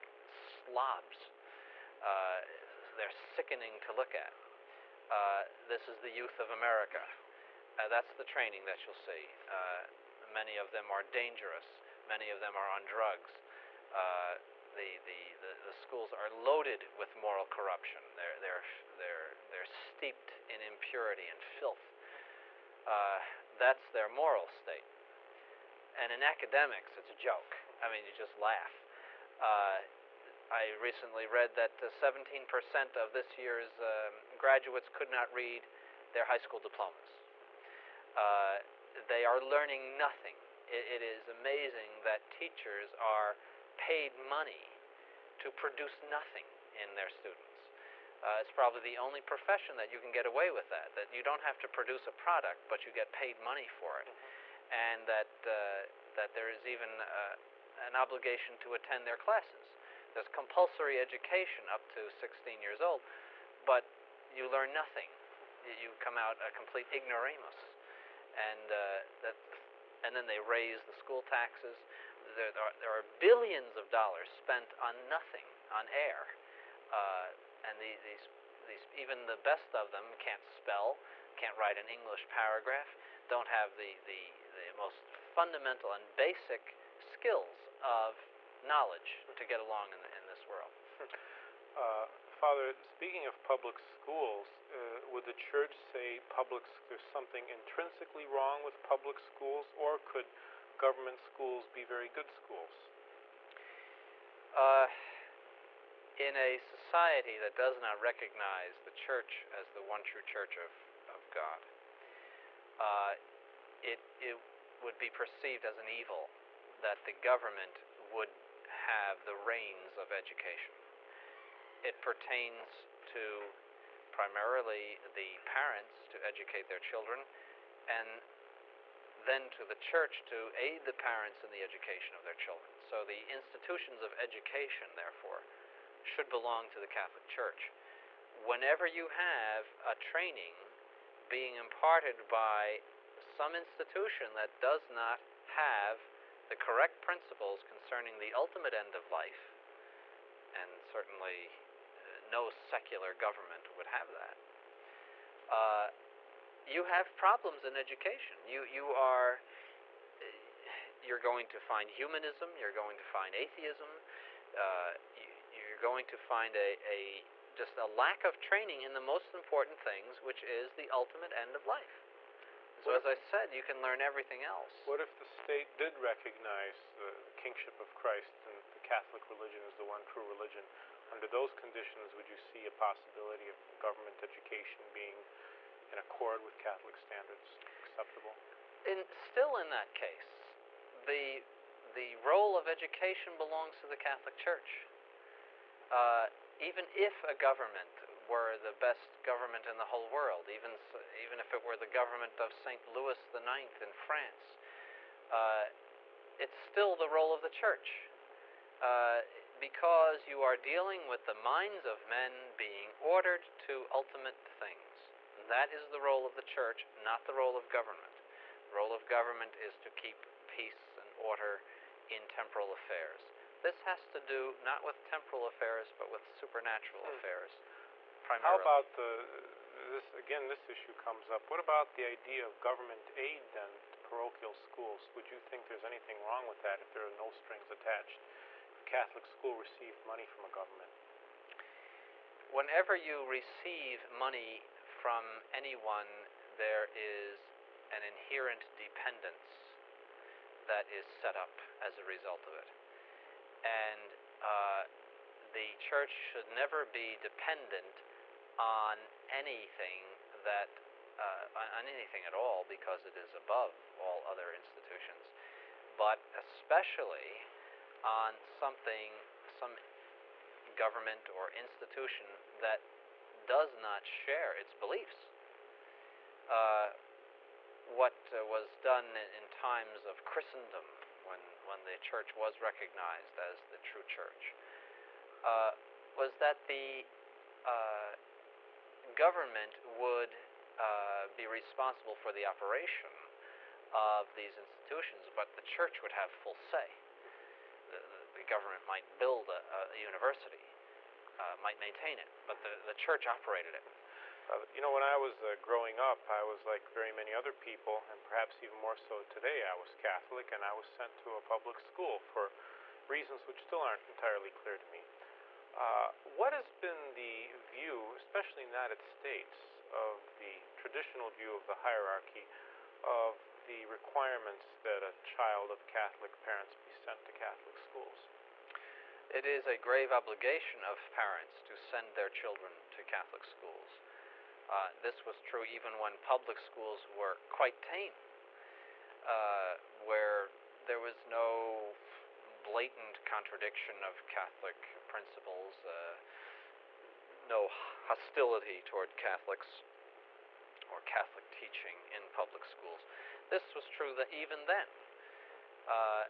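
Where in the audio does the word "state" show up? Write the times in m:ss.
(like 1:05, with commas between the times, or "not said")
0:24, 2:55, 5:18.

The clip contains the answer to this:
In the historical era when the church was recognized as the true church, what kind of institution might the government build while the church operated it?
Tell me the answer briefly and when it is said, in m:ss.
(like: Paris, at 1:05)
a university, at 4:59.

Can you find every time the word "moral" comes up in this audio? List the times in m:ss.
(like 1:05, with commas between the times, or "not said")
0:17, 0:24.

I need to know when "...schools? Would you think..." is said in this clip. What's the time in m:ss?
3:54.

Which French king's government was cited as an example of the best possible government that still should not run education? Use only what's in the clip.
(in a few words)
St. Louis the Ninth.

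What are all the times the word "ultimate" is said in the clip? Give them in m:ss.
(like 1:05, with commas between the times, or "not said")
2:28, 2:50, 3:33.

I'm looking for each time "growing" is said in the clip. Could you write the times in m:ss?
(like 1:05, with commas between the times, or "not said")
5:05.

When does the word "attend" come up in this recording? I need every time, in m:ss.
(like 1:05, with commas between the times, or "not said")
0:58.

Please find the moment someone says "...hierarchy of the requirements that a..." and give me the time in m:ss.
5:21.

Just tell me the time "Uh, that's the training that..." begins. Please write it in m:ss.
0:07.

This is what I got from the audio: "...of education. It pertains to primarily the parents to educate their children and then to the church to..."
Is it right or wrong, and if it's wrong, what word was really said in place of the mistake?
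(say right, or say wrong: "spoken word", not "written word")
right.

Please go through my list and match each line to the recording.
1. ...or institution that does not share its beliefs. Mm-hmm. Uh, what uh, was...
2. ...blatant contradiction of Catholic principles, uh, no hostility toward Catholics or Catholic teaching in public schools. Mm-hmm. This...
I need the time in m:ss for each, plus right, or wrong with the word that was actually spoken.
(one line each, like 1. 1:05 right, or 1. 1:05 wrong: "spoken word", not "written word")
1. 4:31 right
2. 5:42 right.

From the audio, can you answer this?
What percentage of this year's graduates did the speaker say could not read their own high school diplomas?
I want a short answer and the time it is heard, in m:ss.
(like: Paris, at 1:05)
17%, at 0:31.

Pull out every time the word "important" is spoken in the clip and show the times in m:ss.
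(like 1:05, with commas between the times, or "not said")
2:49.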